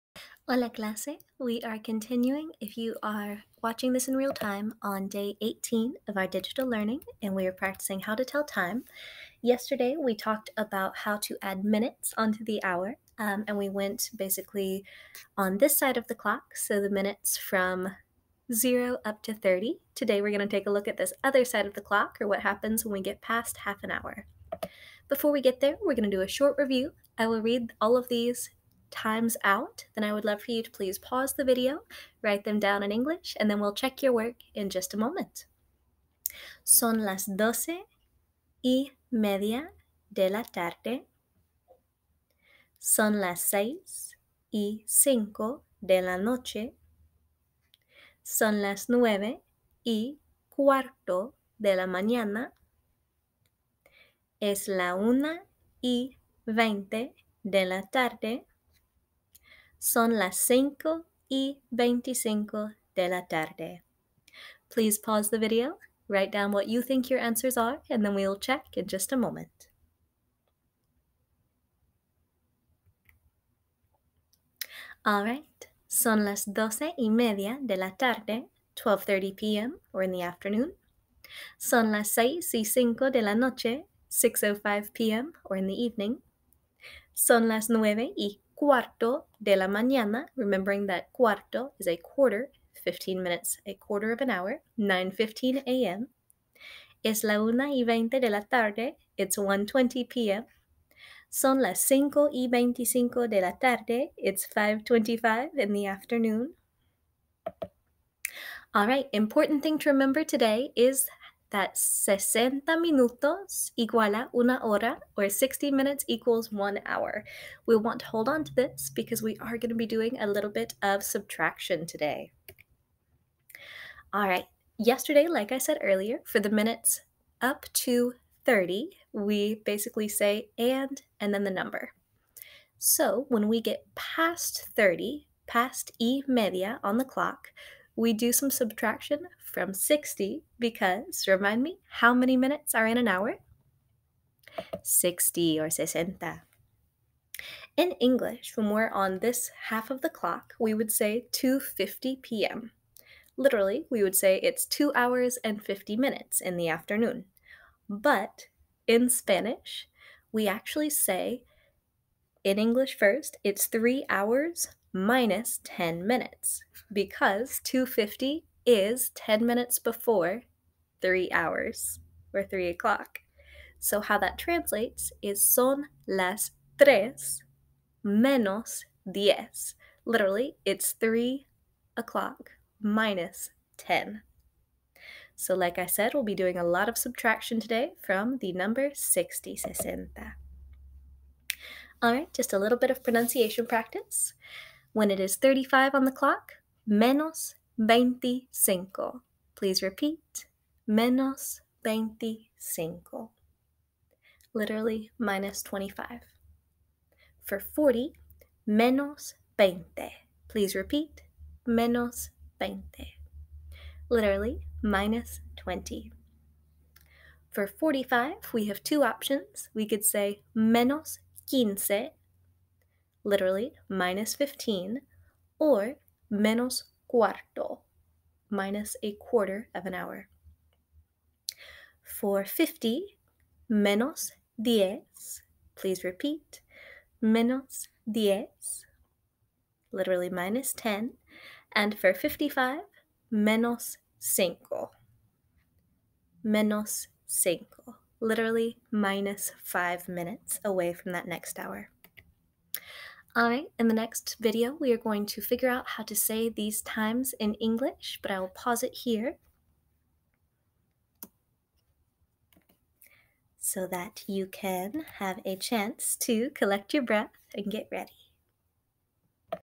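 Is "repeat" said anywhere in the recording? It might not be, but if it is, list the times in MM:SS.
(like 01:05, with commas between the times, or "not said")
03:19, 03:30, 03:56.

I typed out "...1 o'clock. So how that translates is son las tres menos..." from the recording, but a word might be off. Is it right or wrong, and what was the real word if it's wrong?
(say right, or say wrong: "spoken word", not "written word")
wrong: "3", not "1".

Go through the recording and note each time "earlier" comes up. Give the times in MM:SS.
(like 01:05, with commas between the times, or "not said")
02:05.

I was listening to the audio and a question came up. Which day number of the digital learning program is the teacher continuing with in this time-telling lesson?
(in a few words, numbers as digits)
18.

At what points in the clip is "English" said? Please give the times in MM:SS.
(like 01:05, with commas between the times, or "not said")
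00:32, 02:28, 02:42, 04:17.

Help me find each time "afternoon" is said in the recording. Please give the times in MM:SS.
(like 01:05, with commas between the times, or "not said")
01:20, 01:45, 02:36.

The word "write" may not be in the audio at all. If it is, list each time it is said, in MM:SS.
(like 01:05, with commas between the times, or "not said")
00:32, 01:06.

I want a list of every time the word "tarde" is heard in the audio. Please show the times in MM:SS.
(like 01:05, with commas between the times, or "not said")
00:40, 00:57, 01:03, 01:17, 01:38, 01:43.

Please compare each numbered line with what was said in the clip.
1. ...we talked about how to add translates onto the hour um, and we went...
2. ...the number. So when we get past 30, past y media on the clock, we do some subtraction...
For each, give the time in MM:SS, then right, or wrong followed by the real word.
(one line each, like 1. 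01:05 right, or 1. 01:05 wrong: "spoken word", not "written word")
1. 00:09 wrong: "minutes", not "translates"
2. 02:11 right.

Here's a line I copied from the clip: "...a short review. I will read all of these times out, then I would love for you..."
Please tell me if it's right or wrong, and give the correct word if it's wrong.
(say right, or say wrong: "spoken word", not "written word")
right.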